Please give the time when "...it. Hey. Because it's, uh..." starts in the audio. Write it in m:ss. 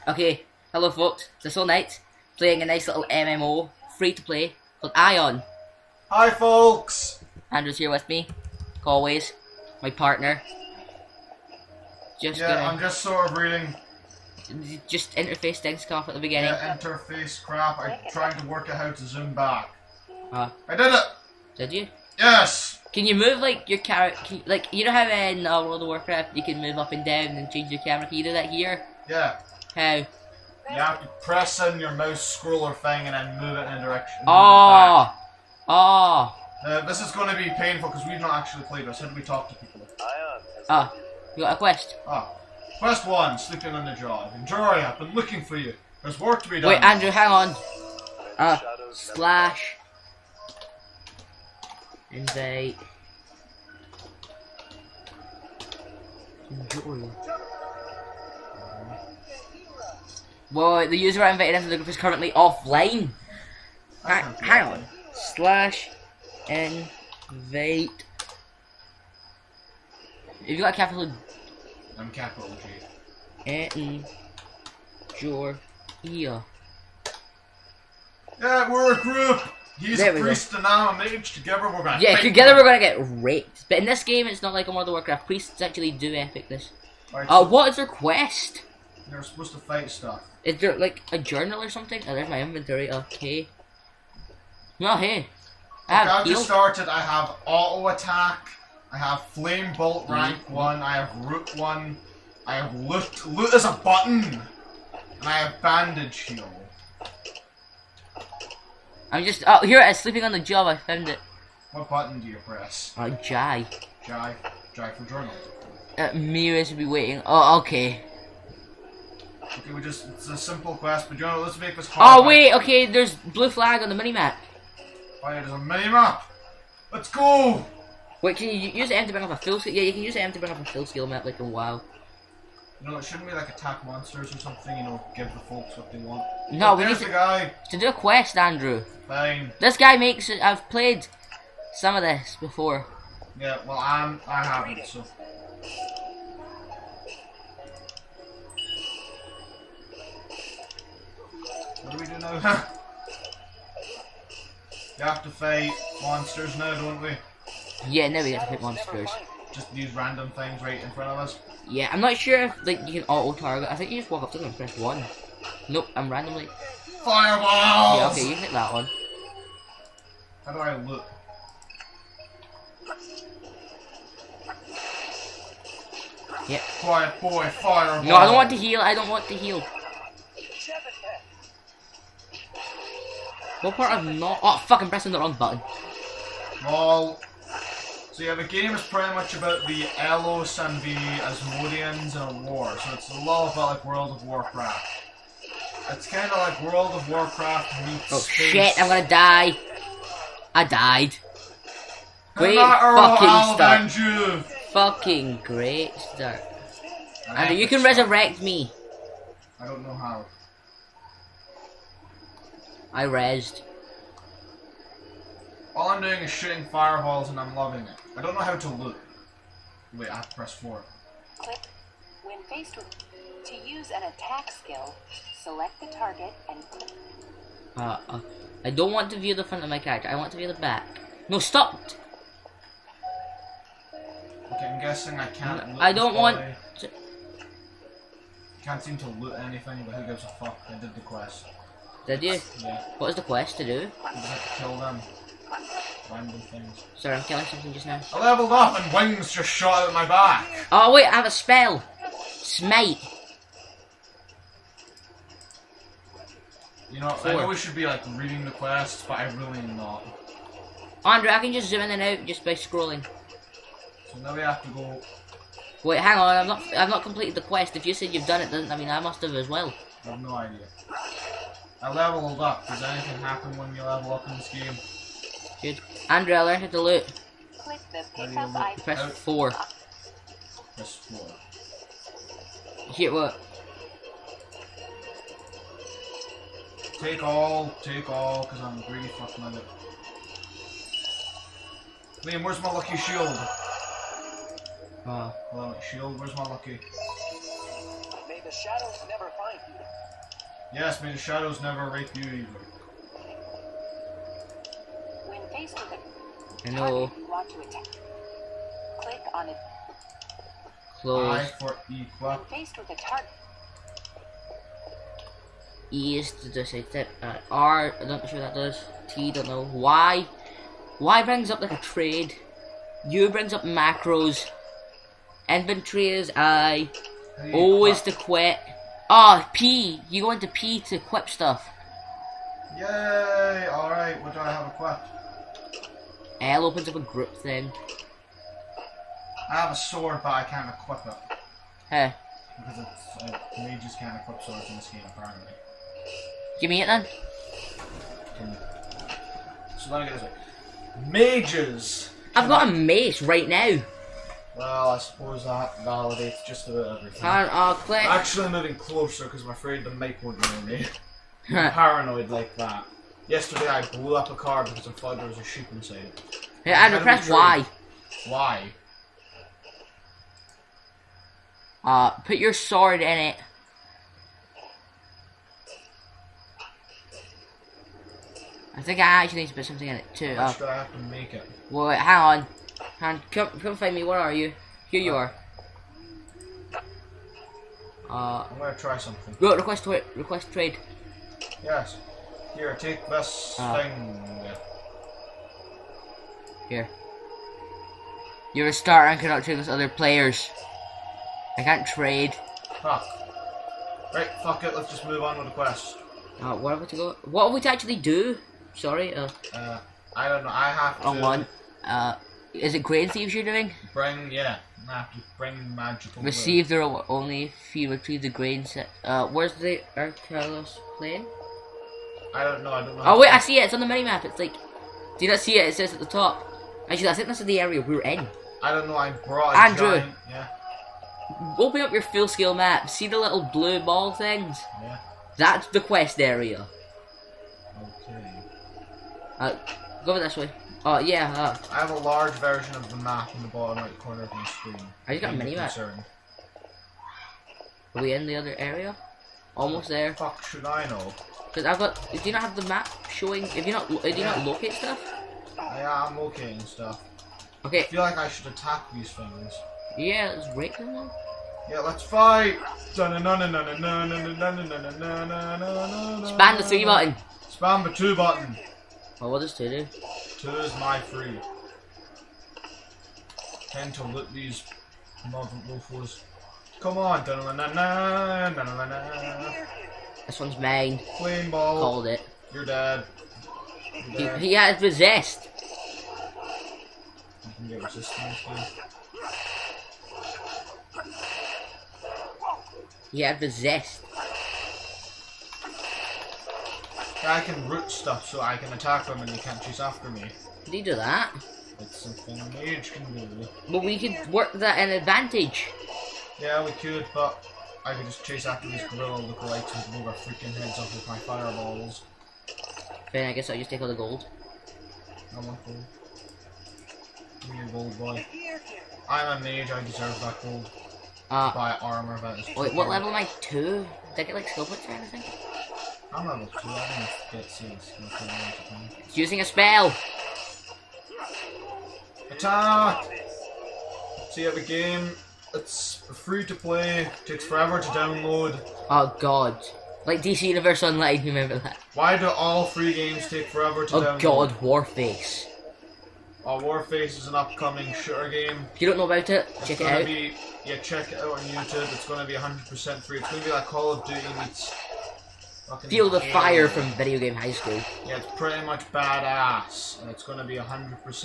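5:41.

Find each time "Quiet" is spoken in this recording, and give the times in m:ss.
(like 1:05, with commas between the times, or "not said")
2:56.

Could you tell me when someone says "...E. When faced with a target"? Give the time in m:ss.
5:11.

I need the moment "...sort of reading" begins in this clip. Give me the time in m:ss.
0:13.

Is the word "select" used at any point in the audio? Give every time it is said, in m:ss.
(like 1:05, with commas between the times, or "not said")
3:45.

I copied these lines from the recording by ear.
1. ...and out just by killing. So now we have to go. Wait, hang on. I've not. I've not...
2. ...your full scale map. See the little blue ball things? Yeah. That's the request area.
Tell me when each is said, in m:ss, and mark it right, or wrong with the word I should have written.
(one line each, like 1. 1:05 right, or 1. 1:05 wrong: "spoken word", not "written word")
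1. 4:21 wrong: "scrolling", not "killing"
2. 7:11 wrong: "quest", not "request".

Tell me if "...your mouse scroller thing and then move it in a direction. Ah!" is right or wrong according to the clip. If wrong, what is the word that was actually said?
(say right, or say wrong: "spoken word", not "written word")
right.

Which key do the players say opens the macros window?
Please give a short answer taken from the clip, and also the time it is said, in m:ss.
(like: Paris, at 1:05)
U, at 5:23.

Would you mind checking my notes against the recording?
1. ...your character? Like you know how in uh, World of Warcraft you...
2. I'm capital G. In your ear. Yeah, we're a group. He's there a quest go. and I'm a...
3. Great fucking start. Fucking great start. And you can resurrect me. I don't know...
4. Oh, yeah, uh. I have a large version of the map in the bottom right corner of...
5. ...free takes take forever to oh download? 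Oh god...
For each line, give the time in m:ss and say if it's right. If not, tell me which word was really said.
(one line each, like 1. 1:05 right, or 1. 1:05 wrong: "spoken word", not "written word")
1. 0:23 right
2. 1:11 wrong: "priest", not "quest"
3. 3:22 right
4. 7:20 right
5. 9:02 wrong: "games", not "takes".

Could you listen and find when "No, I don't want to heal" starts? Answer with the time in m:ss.
2:58.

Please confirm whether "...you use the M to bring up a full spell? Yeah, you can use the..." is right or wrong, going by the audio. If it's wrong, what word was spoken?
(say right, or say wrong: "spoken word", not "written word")
wrong: "skill", not "spell".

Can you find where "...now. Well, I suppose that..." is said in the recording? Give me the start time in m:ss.
5:53.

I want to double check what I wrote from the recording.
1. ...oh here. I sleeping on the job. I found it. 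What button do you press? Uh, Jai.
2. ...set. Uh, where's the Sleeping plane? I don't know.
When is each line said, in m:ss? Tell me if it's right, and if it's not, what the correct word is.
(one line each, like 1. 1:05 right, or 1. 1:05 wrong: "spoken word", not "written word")
1. 1:49 right
2. 6:58 wrong: "Arcalos", not "Sleeping".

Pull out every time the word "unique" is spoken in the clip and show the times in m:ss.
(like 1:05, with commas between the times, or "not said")
not said.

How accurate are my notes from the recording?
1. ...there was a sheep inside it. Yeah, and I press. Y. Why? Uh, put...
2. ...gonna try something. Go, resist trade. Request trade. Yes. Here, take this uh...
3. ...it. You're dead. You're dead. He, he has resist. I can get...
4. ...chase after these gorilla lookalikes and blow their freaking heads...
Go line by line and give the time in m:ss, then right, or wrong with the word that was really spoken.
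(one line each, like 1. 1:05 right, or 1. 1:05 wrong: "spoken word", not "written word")
1. 6:05 right
2. 6:28 wrong: "request", not "resist"
3. 8:02 right
4. 8:28 right.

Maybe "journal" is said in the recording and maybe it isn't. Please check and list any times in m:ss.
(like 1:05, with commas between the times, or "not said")
1:31, 1:55.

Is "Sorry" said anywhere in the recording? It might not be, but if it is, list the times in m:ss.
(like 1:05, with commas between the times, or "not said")
4:06, 6:48.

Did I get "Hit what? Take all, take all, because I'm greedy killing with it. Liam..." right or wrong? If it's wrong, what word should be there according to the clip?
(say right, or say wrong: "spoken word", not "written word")
wrong: "fucking", not "killing".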